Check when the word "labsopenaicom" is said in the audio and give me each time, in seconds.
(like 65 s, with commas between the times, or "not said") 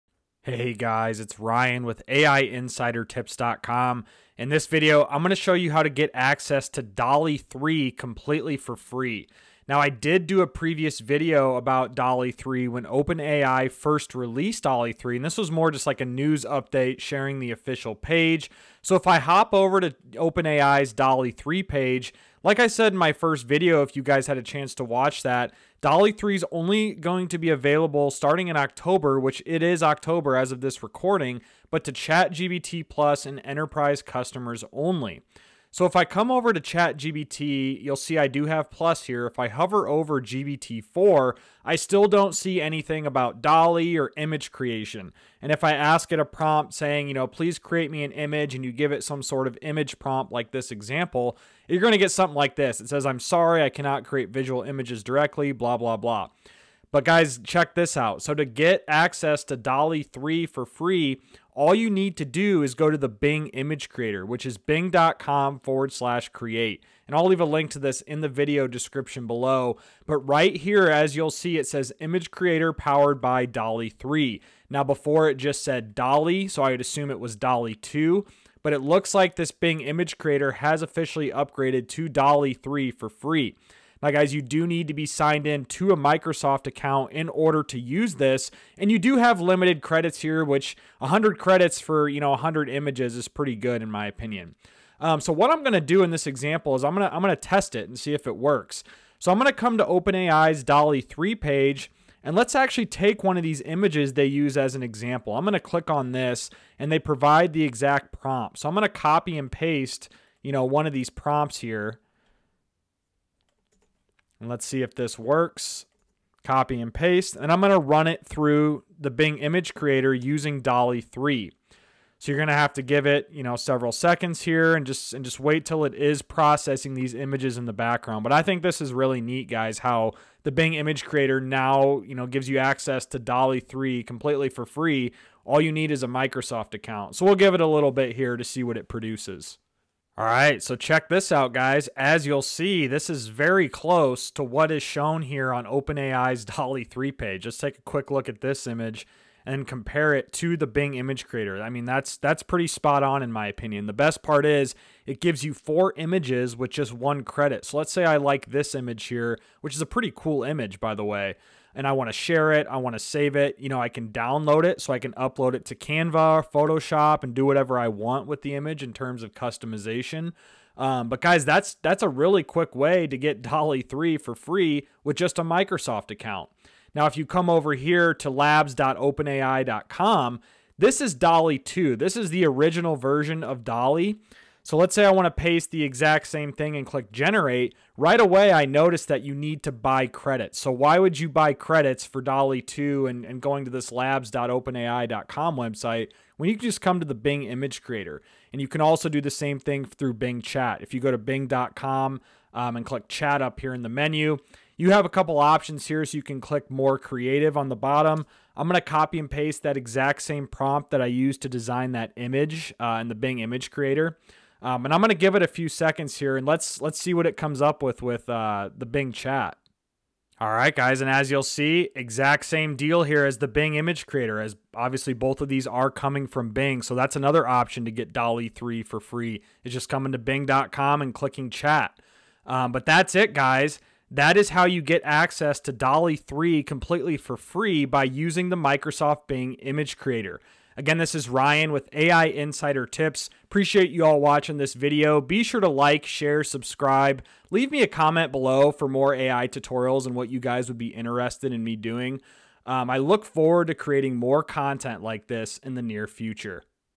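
178 s, 193 s.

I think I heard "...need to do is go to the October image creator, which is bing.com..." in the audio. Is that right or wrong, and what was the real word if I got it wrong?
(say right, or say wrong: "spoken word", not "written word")
wrong: "Bing", not "October".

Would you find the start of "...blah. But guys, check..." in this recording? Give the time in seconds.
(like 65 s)
55 s.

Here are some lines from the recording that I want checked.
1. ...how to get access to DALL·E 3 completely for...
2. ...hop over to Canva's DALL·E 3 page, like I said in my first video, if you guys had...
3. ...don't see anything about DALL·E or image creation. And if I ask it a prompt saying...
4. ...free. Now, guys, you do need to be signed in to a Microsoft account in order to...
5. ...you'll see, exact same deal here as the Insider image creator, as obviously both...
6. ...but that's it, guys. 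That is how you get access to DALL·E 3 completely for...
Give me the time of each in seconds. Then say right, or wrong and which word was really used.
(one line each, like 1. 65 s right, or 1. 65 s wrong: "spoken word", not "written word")
1. 5 s right
2. 19 s wrong: "OpenAI", not "Canva"
3. 42 s right
4. 83 s right
5. 221 s wrong: "Bing", not "Insider"
6. 232 s right.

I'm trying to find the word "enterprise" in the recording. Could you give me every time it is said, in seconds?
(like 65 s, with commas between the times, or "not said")
33 s.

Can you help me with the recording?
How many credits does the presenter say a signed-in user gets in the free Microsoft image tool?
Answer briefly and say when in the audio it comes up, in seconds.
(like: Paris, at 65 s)
100, at 90 s.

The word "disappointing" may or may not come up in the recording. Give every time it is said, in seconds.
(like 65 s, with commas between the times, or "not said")
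not said.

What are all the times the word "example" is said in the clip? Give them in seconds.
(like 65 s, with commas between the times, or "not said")
50 s, 96 s, 104 s.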